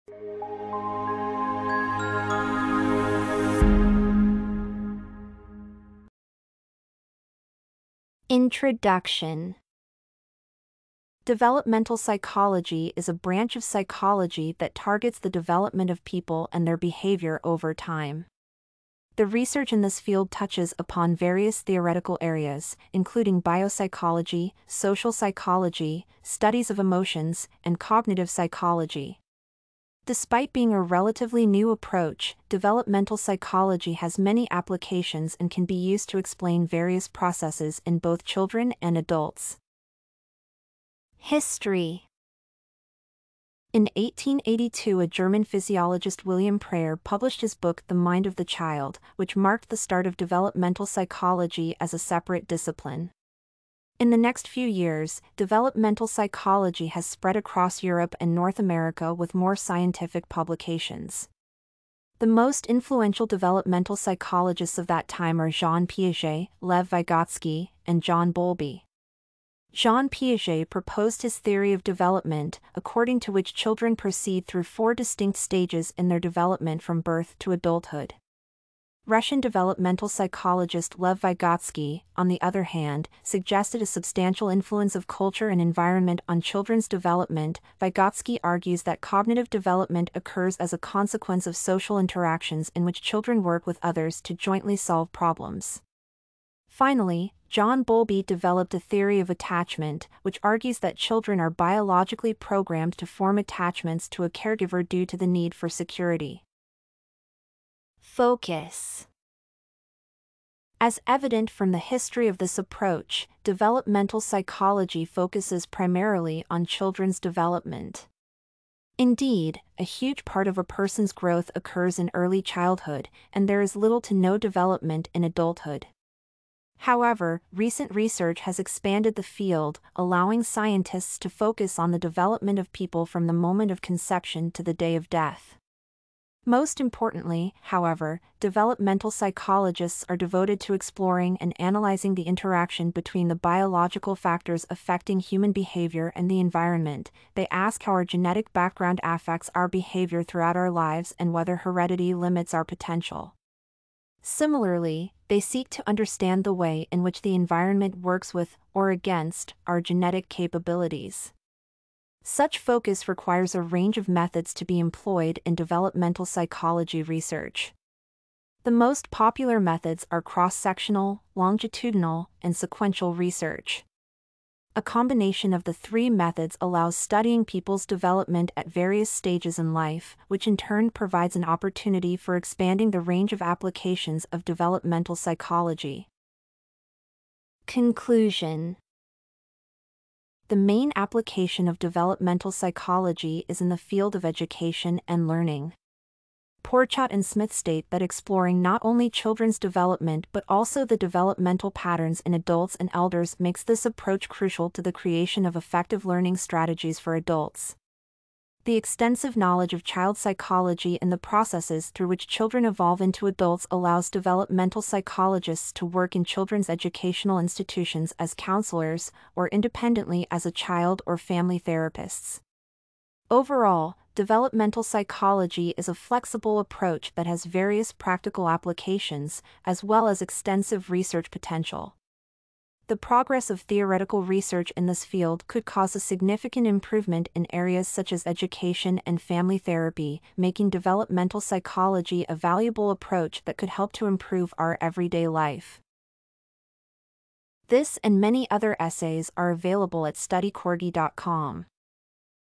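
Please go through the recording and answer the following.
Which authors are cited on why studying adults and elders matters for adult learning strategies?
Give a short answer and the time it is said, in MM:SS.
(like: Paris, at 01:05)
Pourchot and Smith, at 03:16.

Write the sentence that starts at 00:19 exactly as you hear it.
The research in this field touches upon various theoretical areas, including biopsychology, social psychology, studies of emotions, and cognitive psychology.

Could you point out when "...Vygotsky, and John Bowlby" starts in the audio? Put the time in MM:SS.
01:06.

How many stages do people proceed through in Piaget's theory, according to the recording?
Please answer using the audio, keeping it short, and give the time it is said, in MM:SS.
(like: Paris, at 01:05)
4, at 01:14.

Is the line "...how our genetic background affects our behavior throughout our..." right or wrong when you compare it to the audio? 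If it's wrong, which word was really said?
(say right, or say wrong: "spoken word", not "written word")
right.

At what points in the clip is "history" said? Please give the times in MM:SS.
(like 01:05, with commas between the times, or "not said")
00:41, 01:51.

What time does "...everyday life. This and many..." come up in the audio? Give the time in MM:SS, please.
04:04.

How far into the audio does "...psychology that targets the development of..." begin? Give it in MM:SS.
00:13.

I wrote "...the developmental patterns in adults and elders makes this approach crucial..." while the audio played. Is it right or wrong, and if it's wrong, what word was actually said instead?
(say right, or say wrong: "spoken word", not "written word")
right.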